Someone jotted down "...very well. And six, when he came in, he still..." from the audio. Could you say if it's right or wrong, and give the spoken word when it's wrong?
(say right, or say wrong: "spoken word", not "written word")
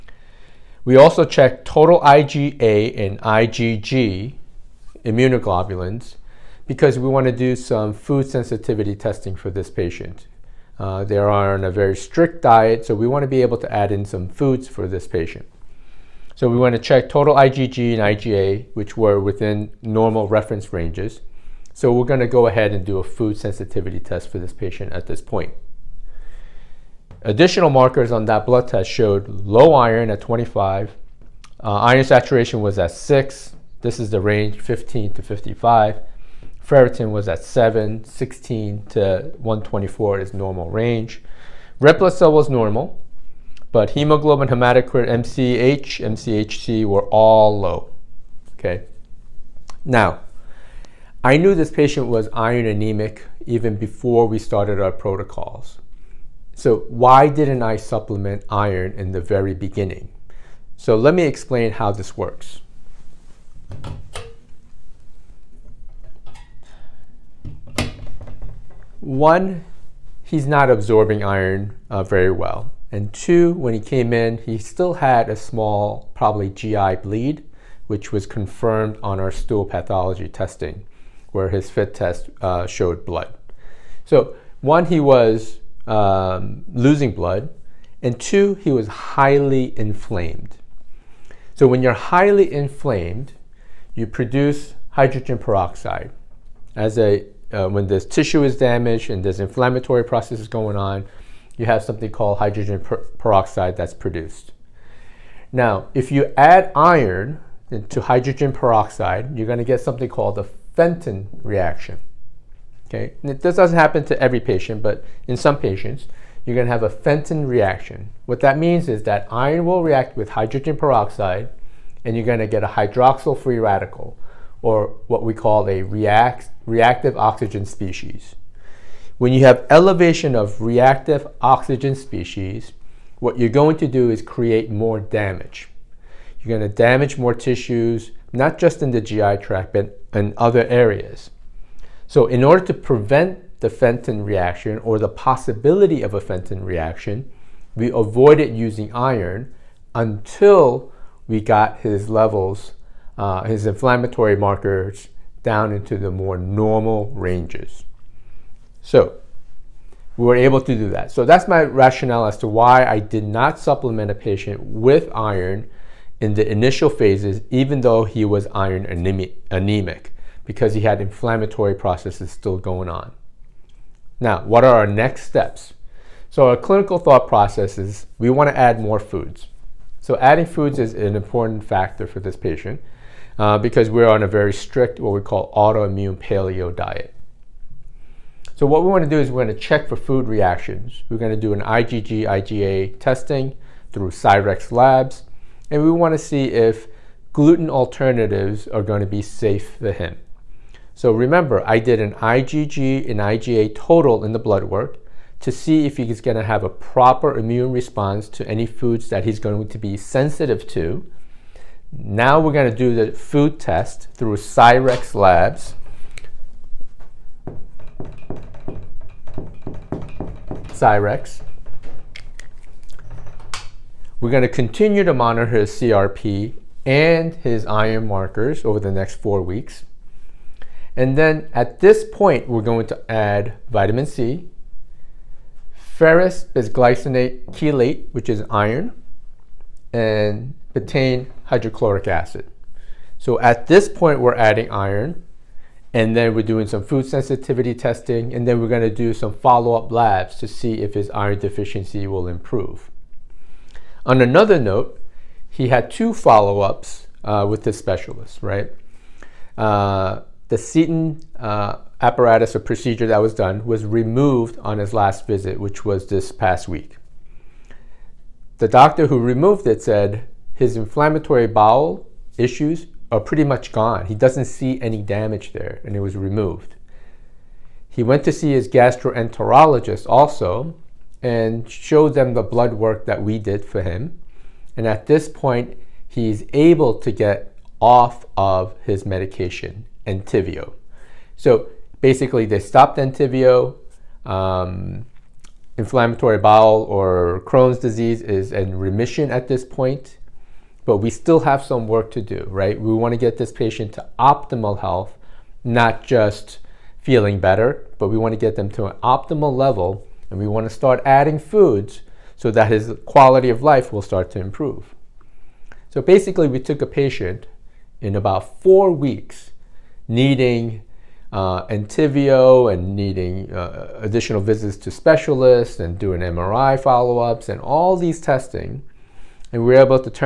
wrong: "two", not "six".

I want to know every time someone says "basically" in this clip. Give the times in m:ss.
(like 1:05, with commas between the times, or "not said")
4:52, 5:16.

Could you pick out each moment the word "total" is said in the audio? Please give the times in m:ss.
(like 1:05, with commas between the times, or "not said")
0:01, 0:17, 3:23.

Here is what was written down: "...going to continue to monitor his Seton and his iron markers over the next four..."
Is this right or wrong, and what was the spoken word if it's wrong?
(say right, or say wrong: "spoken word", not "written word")
wrong: "CRP", not "Seton".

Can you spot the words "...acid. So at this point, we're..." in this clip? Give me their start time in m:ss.
4:02.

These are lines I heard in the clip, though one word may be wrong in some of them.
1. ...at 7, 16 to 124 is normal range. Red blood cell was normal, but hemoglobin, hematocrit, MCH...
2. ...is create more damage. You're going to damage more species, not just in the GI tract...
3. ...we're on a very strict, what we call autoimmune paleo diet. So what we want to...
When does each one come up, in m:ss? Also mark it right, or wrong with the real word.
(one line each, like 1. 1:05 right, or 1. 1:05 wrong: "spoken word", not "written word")
1. 0:37 right
2. 2:14 wrong: "tissues", not "species"
3. 3:03 right.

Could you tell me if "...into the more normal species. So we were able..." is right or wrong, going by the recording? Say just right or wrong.
wrong.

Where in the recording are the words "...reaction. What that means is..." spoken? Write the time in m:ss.
1:57.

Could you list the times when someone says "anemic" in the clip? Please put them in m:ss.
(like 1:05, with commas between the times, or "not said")
0:52, 2:48.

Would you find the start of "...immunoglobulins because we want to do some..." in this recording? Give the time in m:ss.
0:05.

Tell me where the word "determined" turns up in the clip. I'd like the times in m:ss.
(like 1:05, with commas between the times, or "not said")
not said.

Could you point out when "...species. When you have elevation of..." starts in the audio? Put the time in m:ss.
2:07.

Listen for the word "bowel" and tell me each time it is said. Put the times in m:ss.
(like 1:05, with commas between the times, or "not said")
4:31, 4:56.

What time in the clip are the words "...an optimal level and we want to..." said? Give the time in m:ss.
5:08.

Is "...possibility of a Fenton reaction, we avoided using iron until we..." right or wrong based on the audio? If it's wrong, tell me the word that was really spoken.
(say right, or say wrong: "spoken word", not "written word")
right.